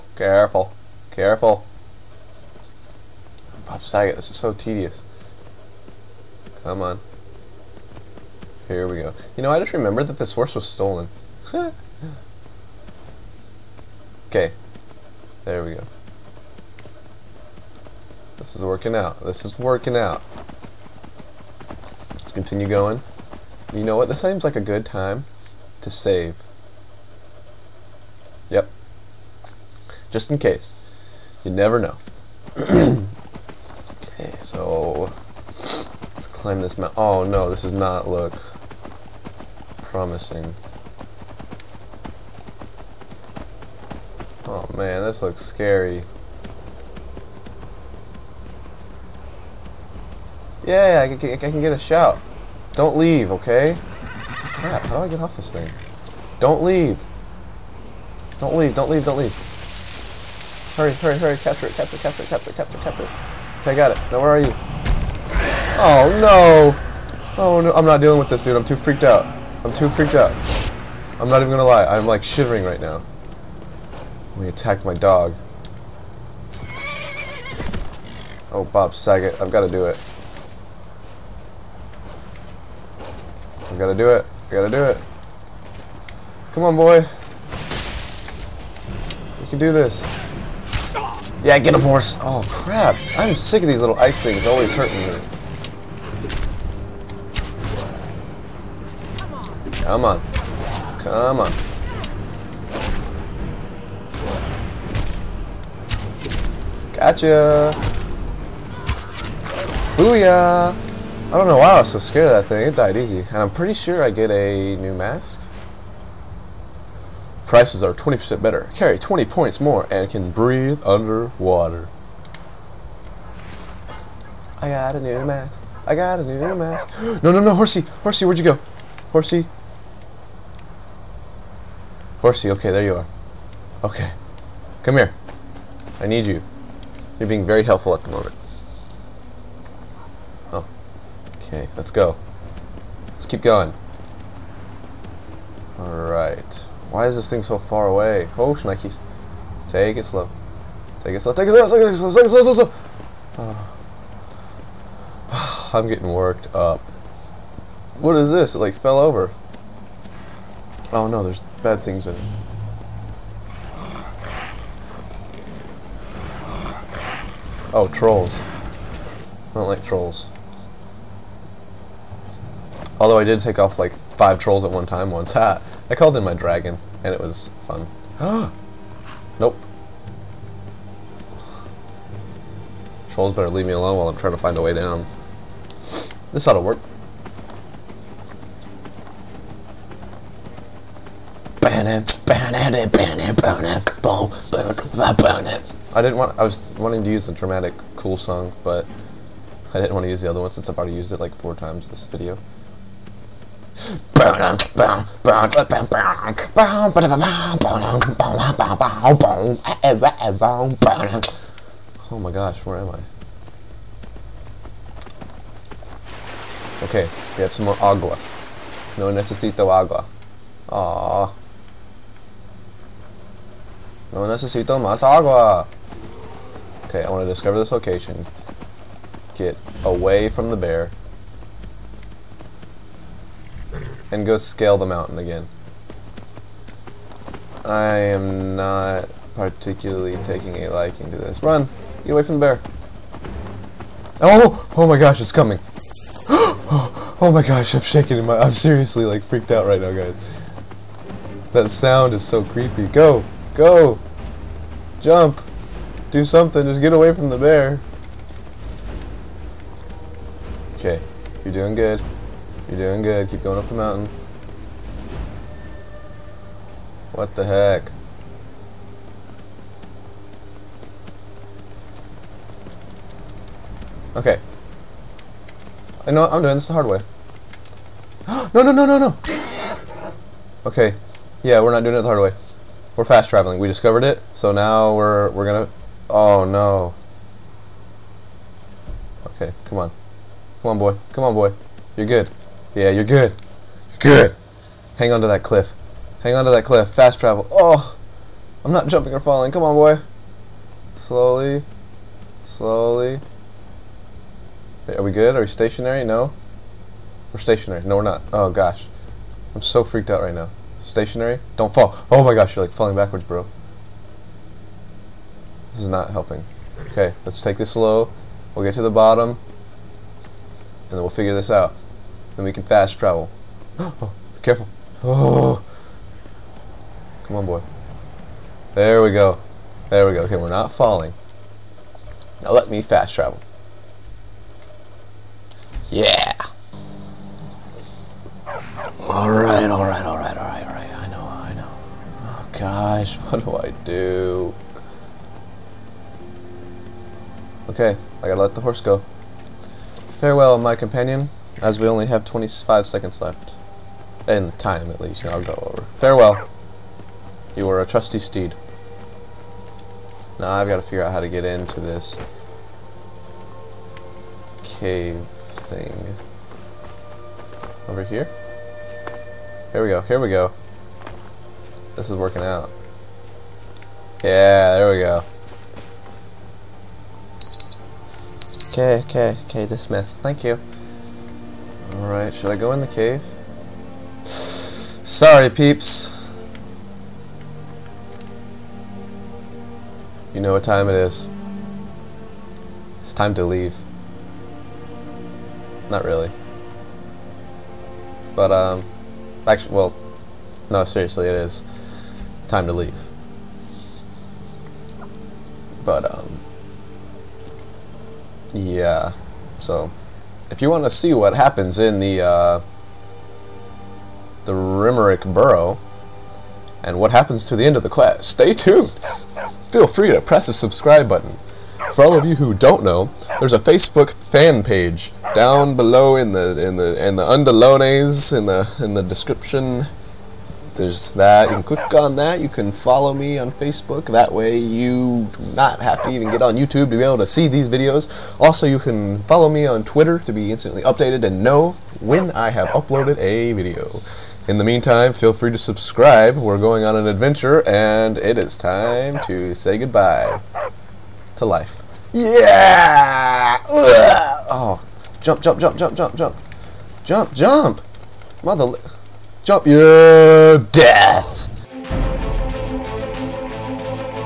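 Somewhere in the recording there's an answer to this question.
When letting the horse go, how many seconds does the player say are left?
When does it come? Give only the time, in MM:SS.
05:52.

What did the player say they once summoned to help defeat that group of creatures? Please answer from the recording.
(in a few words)
My dragon.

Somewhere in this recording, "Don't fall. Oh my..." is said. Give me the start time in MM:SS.
05:11.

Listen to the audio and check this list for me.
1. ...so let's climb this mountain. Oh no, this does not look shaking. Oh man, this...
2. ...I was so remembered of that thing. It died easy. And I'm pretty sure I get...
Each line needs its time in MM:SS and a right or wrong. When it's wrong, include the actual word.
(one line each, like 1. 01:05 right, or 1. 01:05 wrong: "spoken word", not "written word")
1. 00:34 wrong: "promising", not "shaking"
2. 01:51 wrong: "scared", not "remembered".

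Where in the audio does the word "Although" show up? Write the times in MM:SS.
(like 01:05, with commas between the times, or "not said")
02:53.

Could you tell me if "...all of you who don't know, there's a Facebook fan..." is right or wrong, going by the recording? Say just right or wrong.
right.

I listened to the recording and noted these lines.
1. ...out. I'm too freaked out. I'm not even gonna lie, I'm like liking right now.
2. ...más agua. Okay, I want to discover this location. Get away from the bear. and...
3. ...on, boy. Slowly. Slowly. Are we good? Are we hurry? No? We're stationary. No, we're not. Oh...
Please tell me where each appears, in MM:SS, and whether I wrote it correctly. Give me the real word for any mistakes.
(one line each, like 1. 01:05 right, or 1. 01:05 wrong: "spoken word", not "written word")
1. 01:09 wrong: "shivering", not "liking"
2. 03:44 right
3. 04:59 wrong: "stationary", not "hurry".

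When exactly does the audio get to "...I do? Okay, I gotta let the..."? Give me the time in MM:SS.
05:43.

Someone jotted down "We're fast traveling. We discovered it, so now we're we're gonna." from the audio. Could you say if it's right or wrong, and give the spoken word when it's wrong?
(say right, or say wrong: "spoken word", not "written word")
right.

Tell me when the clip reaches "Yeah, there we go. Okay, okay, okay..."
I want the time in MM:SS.
06:14.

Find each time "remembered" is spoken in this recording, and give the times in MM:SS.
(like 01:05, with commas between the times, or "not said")
00:09.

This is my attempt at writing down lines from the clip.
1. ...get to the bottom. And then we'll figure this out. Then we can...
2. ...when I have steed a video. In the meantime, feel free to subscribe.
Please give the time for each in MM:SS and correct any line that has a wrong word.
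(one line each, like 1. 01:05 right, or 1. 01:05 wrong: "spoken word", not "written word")
1. 05:18 right
2. 07:22 wrong: "uploaded", not "steed".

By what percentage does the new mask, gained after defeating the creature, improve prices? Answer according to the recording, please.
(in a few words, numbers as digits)
20%.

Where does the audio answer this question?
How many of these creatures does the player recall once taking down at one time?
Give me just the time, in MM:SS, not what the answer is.
02:53.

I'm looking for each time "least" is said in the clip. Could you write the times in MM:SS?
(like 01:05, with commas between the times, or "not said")
05:55.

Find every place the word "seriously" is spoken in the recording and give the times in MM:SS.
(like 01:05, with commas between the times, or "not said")
04:08, 06:40.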